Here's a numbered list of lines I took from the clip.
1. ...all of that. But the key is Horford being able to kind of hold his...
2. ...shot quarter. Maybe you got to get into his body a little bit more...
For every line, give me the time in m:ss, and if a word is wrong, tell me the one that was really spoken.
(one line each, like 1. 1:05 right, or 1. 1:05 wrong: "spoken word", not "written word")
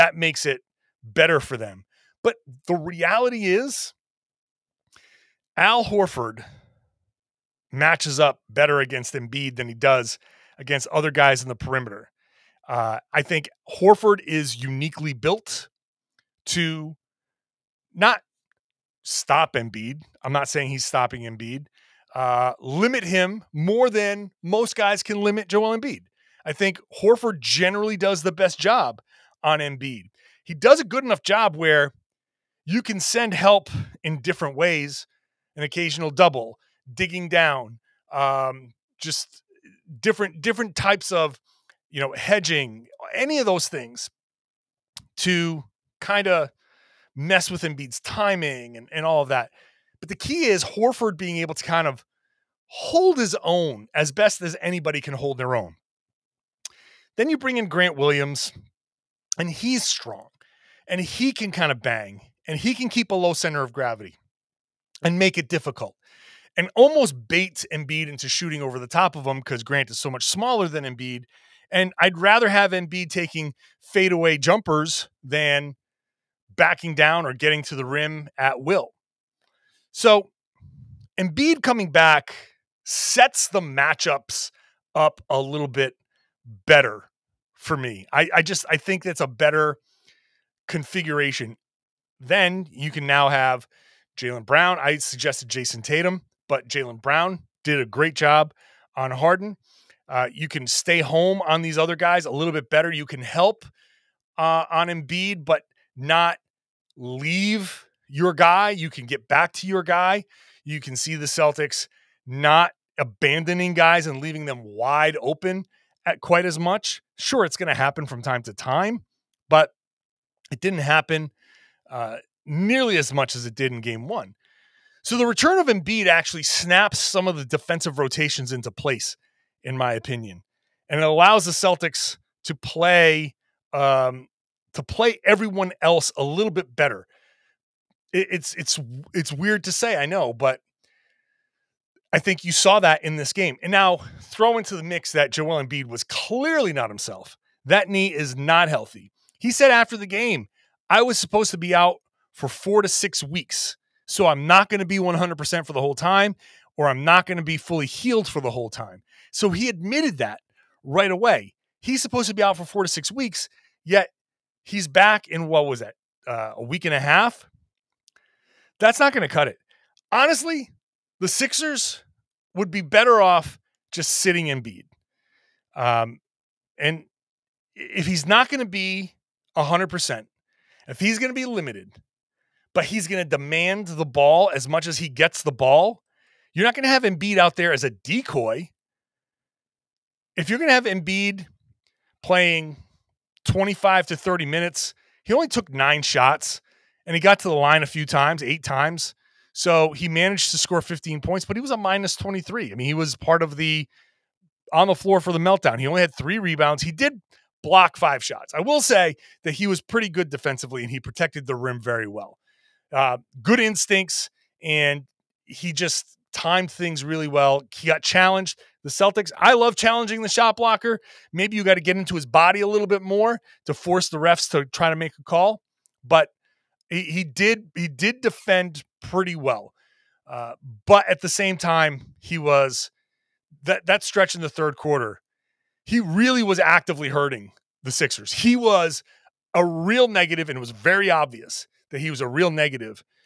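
1. 0:49 right
2. 3:40 wrong: "blocker", not "quarter".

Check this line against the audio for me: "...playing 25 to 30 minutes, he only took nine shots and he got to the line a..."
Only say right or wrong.
right.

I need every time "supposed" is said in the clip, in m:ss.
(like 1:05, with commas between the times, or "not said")
2:31, 2:42.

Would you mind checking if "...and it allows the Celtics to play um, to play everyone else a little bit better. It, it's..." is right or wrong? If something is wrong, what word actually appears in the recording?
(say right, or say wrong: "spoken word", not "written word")
right.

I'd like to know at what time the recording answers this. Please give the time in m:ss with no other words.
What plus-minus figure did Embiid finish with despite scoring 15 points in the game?
3:21.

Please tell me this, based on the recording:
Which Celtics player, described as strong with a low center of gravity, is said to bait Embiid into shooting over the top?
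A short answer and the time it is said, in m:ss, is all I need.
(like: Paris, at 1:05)
Grant Williams, at 0:57.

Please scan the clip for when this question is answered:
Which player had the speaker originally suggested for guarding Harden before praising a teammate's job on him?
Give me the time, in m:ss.
1:35.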